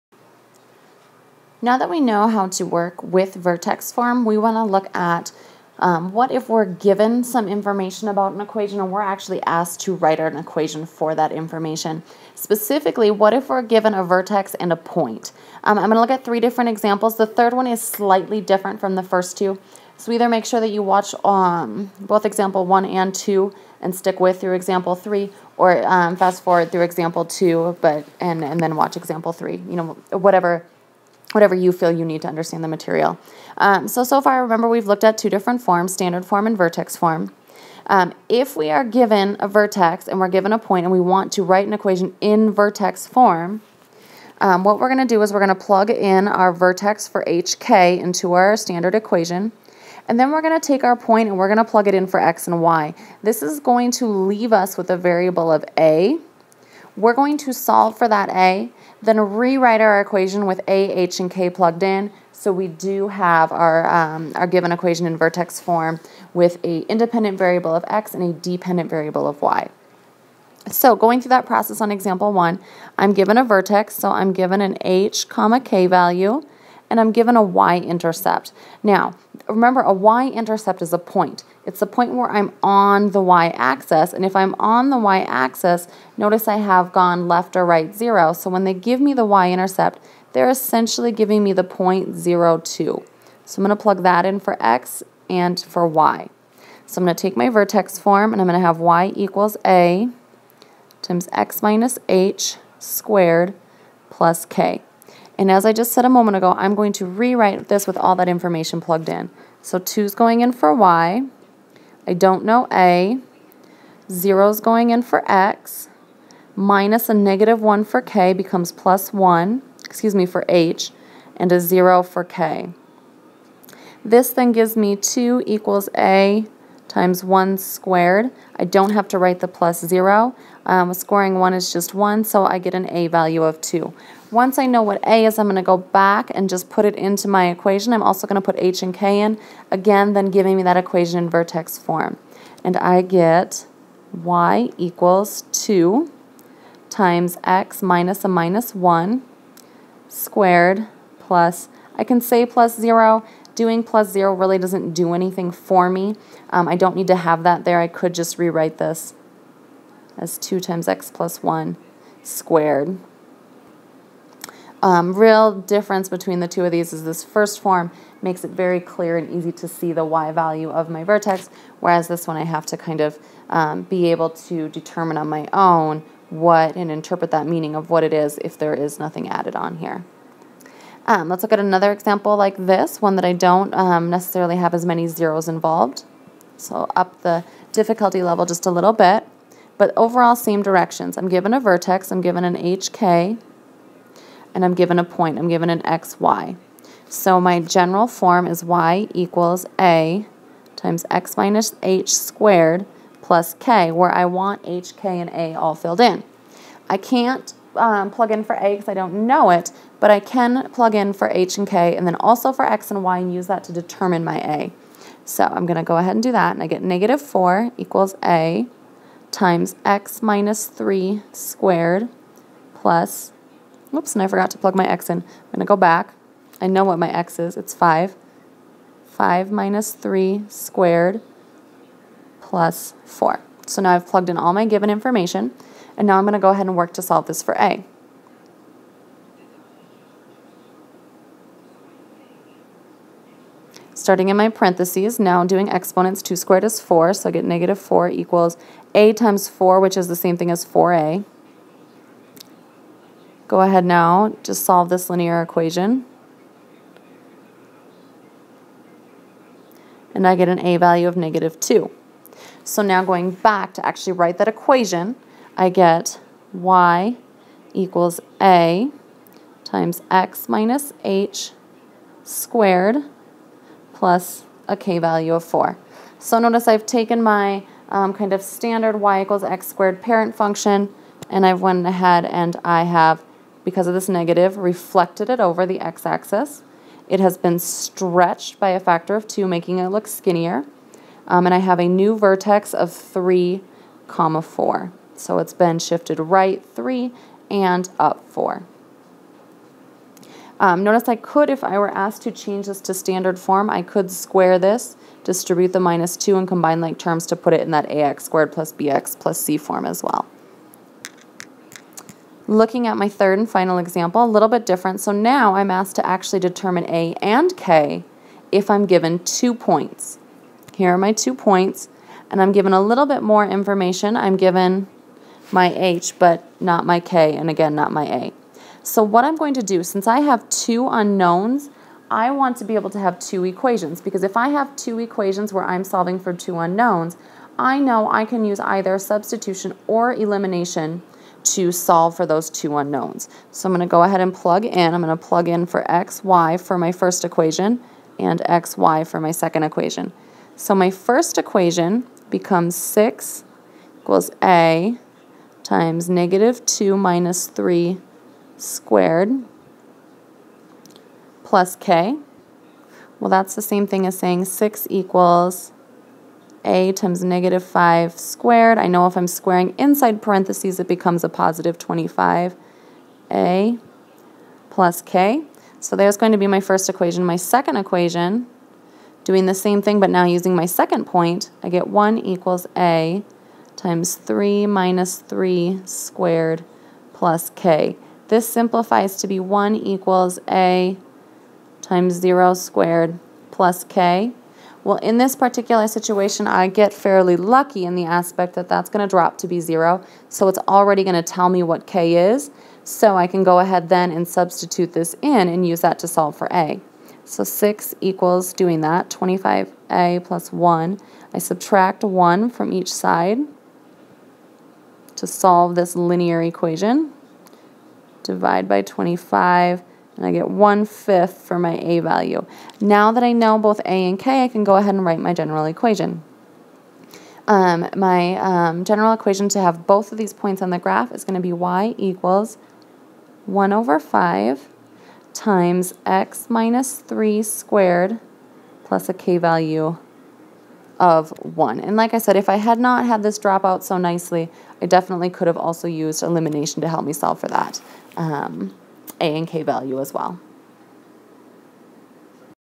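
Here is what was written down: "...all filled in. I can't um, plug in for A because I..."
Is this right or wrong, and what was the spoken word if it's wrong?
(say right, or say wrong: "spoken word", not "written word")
right.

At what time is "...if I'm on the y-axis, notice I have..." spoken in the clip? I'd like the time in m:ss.
1:24.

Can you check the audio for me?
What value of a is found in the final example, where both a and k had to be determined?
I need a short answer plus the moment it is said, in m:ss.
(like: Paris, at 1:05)
1/5, at 7:00.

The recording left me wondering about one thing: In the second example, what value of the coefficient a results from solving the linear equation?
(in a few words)
-2.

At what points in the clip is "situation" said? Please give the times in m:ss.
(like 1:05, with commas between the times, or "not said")
6:35.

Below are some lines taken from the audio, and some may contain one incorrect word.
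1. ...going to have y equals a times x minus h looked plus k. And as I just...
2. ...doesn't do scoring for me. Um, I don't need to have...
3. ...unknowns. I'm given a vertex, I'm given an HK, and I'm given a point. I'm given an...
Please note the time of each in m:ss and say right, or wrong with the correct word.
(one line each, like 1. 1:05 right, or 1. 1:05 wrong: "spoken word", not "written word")
1. 1:38 wrong: "squared", not "looked"
2. 2:34 wrong: "anything", not "scoring"
3. 3:10 wrong: "directions", not "unknowns".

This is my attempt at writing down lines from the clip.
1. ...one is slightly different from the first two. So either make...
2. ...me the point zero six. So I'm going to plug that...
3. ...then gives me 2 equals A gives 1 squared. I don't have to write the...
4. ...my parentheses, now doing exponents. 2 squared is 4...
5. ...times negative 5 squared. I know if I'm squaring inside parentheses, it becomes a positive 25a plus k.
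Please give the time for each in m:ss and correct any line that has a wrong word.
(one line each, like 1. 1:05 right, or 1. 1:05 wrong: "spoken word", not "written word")
1. 0:17 right
2. 1:31 wrong: "two", not "six"
3. 2:04 wrong: "times", not "gives"
4. 4:04 right
5. 6:06 right.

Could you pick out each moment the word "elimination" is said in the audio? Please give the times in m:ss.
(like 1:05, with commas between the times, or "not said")
5:40, 7:26.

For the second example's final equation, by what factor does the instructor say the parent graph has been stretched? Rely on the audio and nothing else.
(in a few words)
2.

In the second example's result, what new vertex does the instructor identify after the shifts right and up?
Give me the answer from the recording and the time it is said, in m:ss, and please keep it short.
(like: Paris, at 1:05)
(3, 4), at 4:52.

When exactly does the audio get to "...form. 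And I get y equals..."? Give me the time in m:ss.
2:21.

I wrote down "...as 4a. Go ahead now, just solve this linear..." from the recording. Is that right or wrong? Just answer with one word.
right.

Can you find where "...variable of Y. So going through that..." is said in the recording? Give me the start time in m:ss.
1:08.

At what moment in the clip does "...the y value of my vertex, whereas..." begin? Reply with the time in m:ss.
2:49.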